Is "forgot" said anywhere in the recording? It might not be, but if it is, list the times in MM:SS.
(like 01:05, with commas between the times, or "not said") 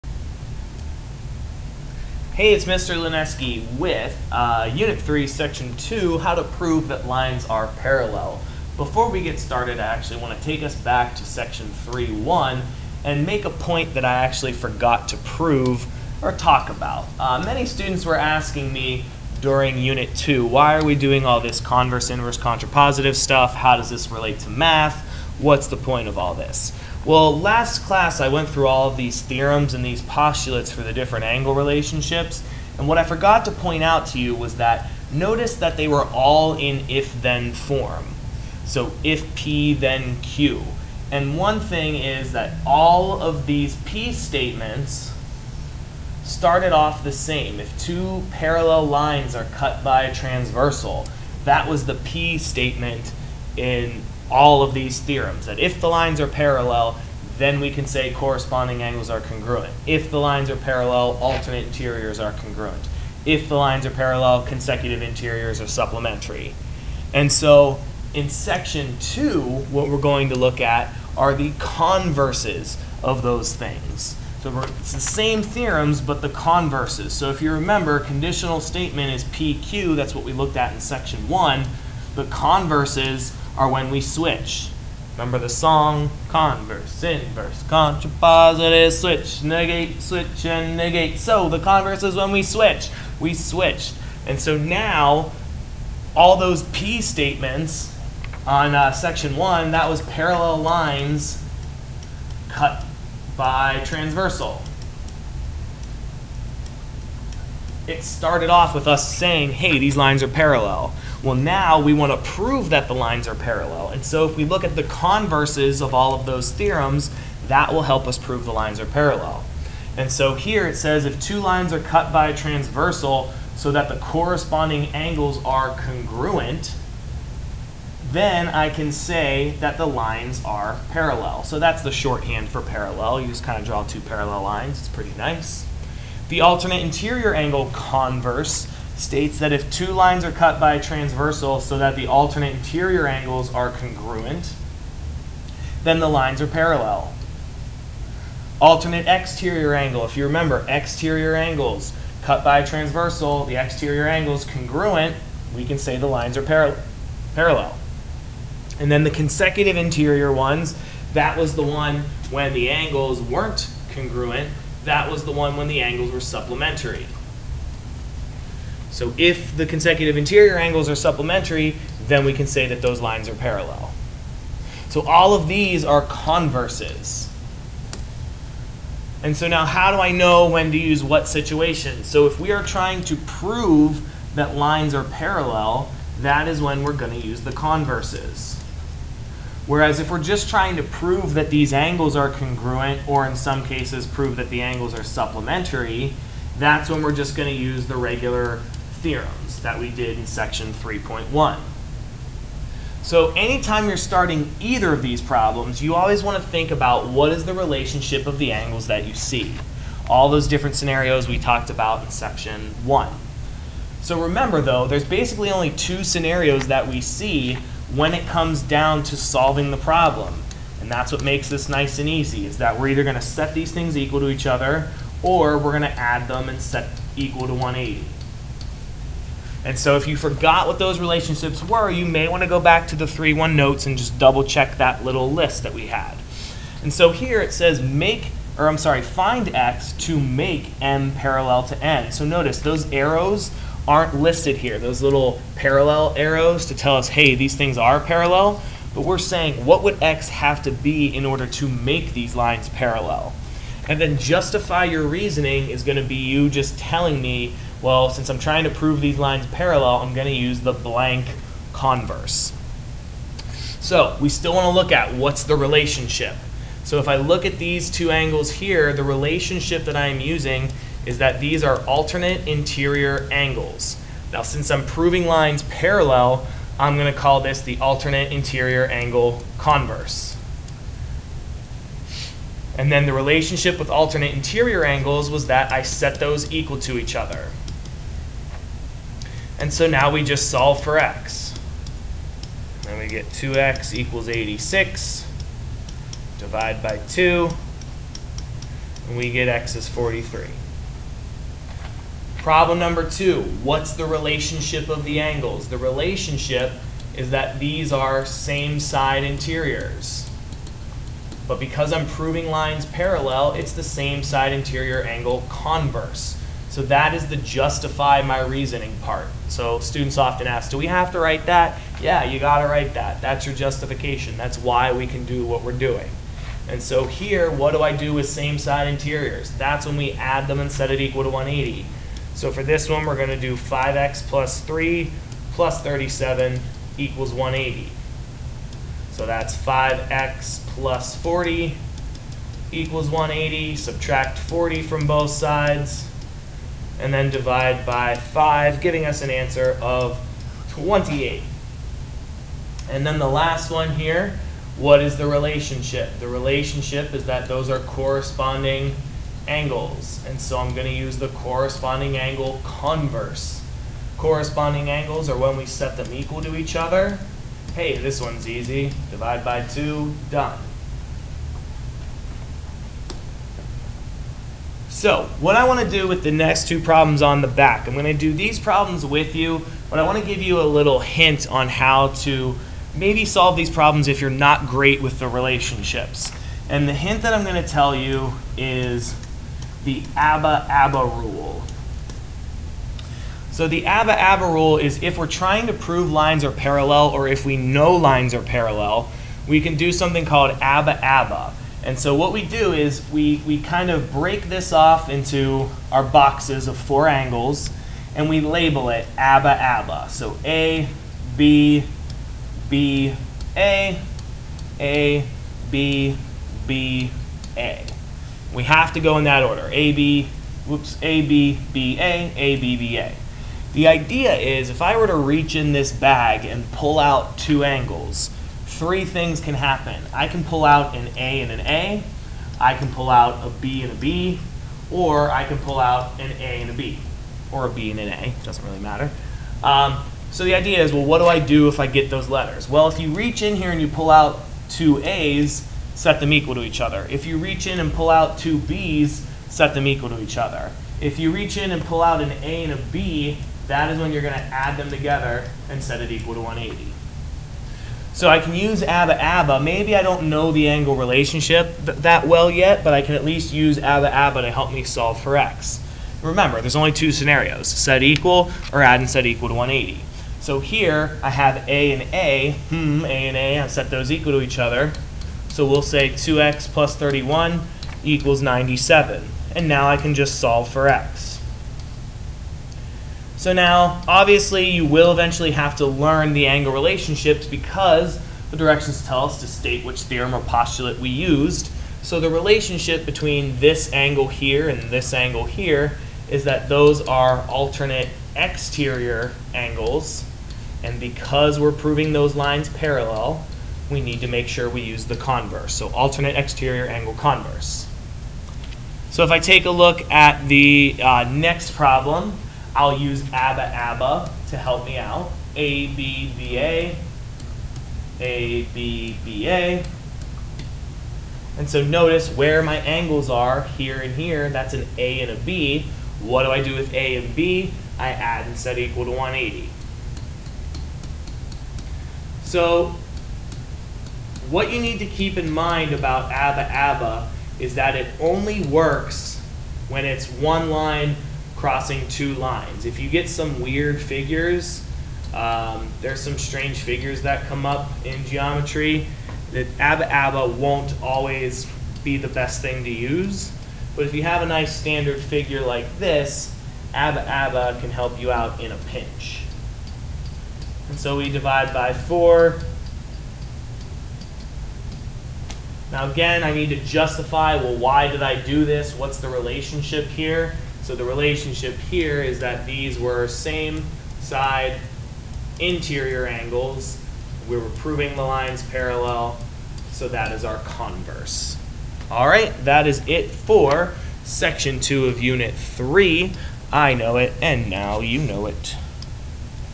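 00:14, 00:33, 03:50.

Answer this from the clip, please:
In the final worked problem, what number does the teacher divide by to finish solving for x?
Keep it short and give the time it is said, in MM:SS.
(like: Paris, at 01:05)
4, at 09:21.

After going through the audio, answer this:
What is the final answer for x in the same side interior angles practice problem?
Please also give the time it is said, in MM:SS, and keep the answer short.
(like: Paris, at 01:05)
28, at 05:50.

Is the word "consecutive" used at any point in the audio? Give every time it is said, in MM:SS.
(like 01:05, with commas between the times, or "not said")
01:04, 02:39, 02:49.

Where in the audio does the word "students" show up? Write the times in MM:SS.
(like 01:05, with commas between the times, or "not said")
00:17, 05:19.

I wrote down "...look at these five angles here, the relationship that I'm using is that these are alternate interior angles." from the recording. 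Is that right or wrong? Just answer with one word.
wrong.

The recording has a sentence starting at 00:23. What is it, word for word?
How does this relate to math?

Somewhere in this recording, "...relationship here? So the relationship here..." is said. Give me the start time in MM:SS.
09:29.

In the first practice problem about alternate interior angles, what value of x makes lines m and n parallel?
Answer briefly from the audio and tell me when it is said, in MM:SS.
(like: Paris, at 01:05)
43, at 04:59.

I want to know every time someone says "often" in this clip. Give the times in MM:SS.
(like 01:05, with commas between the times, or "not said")
05:20.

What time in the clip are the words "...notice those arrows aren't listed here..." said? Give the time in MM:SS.
04:02.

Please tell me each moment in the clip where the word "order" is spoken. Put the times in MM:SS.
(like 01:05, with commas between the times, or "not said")
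04:11, 06:59.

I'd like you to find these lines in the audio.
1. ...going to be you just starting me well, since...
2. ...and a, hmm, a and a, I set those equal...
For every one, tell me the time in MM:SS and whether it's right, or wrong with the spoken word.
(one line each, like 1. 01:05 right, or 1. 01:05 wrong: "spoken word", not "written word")
1. 04:15 wrong: "telling", not "starting"
2. 07:51 right.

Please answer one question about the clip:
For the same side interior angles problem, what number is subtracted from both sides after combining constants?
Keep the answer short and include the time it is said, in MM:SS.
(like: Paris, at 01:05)
40, at 05:43.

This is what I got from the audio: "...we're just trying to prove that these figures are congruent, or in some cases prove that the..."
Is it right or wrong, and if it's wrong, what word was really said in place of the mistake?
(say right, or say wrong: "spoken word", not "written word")
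wrong: "angles", not "figures".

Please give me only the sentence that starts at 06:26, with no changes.
And the hint that I'm going to tell you is the ABBA ABBA rule.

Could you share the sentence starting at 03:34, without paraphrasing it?
So remember though, there's basically only two scenarios that we see when it comes down to solving the problem.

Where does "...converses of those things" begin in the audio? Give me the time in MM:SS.
01:11.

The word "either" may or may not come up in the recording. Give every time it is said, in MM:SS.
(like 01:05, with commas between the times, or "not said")
03:24, 03:42.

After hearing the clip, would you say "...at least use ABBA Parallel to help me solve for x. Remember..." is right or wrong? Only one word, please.
wrong.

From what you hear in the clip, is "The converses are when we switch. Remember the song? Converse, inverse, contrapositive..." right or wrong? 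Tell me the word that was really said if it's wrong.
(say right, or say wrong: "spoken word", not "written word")
right.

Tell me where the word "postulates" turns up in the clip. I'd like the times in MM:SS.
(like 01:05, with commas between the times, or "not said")
00:30, 08:10.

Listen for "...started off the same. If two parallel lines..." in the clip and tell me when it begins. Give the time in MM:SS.
00:46.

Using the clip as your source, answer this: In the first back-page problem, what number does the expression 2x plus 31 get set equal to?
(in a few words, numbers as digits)
97.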